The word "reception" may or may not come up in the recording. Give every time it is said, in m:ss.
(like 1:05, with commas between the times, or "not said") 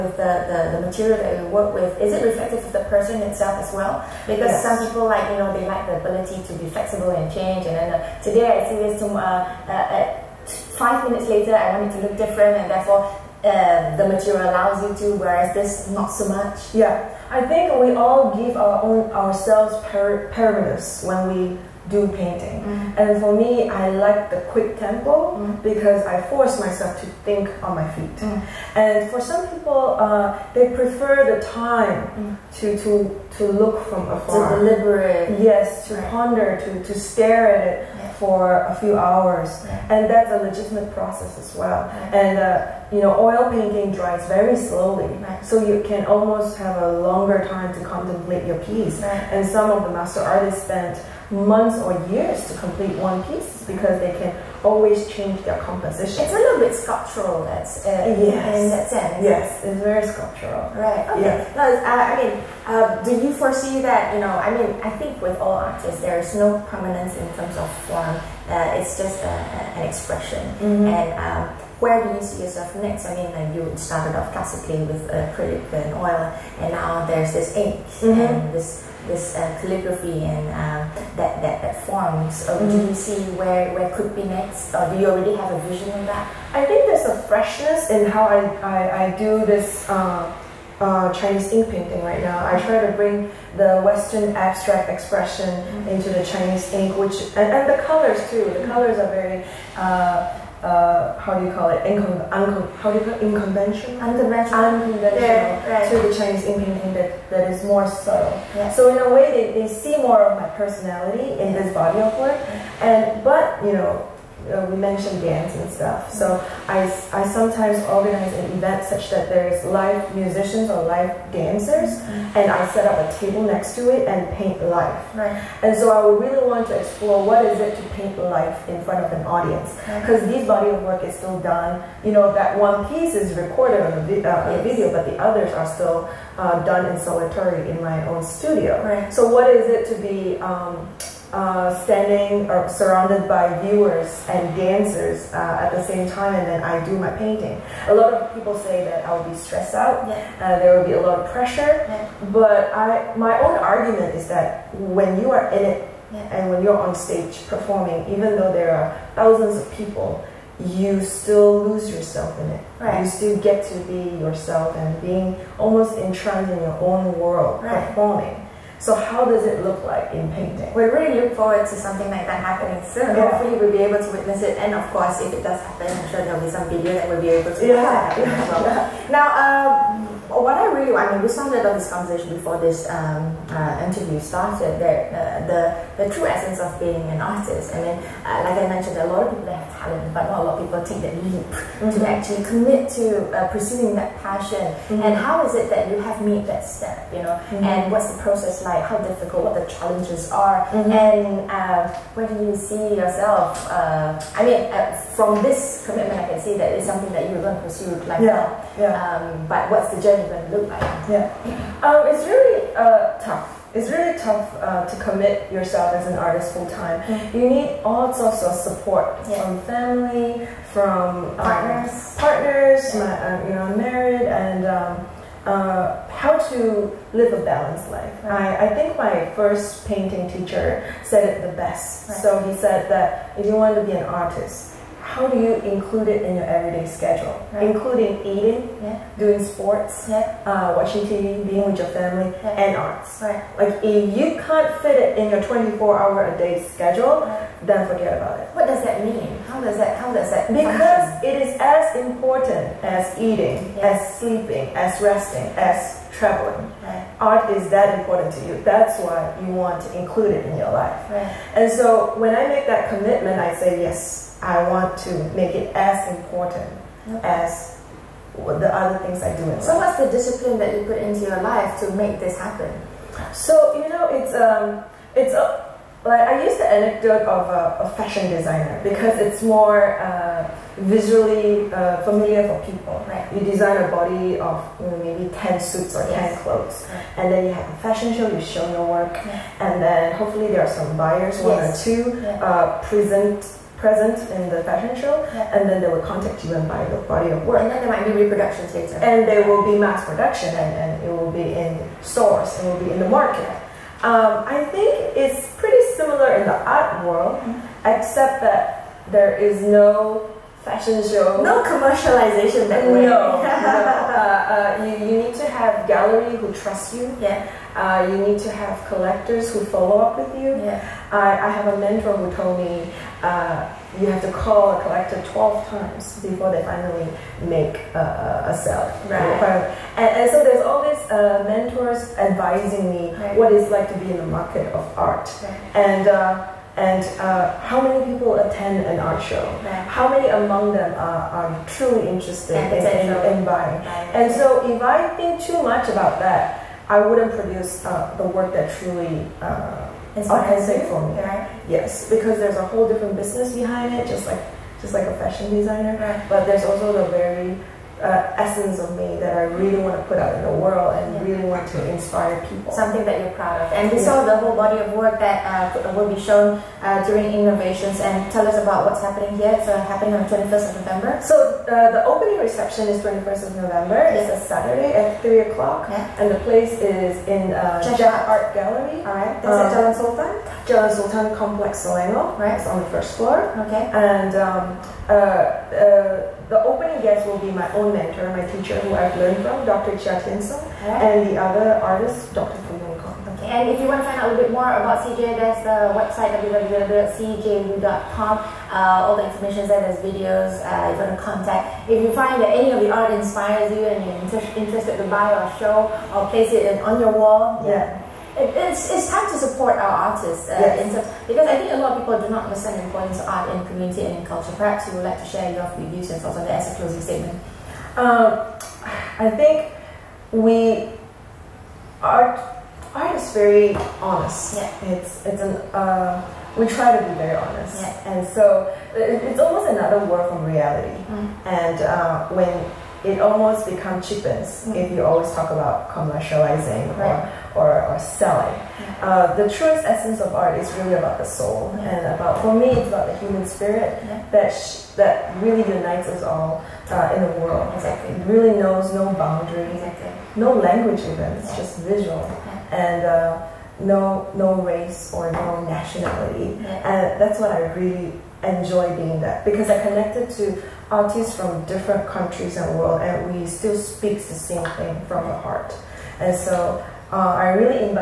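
6:12.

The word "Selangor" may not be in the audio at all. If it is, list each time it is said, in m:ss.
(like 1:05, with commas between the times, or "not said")
6:21.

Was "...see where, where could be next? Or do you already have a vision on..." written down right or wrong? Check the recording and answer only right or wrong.
right.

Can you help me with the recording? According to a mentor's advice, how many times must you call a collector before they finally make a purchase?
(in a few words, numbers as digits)
12.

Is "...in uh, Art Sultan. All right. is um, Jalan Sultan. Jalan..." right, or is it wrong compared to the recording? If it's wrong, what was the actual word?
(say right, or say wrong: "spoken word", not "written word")
wrong: "Gallery", not "Sultan".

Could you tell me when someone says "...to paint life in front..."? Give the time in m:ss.
2:07.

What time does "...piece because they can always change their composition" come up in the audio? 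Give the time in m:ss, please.
0:53.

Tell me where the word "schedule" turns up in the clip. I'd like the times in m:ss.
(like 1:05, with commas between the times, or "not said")
3:56, 4:06.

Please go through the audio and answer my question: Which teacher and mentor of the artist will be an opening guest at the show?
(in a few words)
Dr. Cheah Thien Soong.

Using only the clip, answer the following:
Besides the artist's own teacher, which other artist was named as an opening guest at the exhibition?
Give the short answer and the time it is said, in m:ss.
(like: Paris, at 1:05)
Dr. Foo Yong Kong, at 6:32.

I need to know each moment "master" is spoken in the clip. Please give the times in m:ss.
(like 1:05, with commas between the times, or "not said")
0:49.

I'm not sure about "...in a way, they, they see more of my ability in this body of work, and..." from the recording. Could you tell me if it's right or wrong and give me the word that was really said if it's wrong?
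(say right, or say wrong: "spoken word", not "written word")
wrong: "personality", not "ability".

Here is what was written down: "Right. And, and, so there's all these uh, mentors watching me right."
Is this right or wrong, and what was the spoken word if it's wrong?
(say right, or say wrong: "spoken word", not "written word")
wrong: "advising", not "watching".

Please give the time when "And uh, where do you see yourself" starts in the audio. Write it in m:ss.
3:21.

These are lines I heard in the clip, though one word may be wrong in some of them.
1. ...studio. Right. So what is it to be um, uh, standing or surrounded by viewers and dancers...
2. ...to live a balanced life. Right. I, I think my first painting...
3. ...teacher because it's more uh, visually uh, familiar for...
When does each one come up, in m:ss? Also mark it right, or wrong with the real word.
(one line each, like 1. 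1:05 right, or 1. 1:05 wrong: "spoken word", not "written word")
1. 2:18 right
2. 3:46 right
3. 4:38 wrong: "designer", not "teacher".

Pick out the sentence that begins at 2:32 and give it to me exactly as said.
but I, my own argument is that when you are in it yeah.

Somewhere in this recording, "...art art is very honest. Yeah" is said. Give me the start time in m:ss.
7:02.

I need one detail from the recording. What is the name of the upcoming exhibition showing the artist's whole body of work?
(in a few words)
Inknovations.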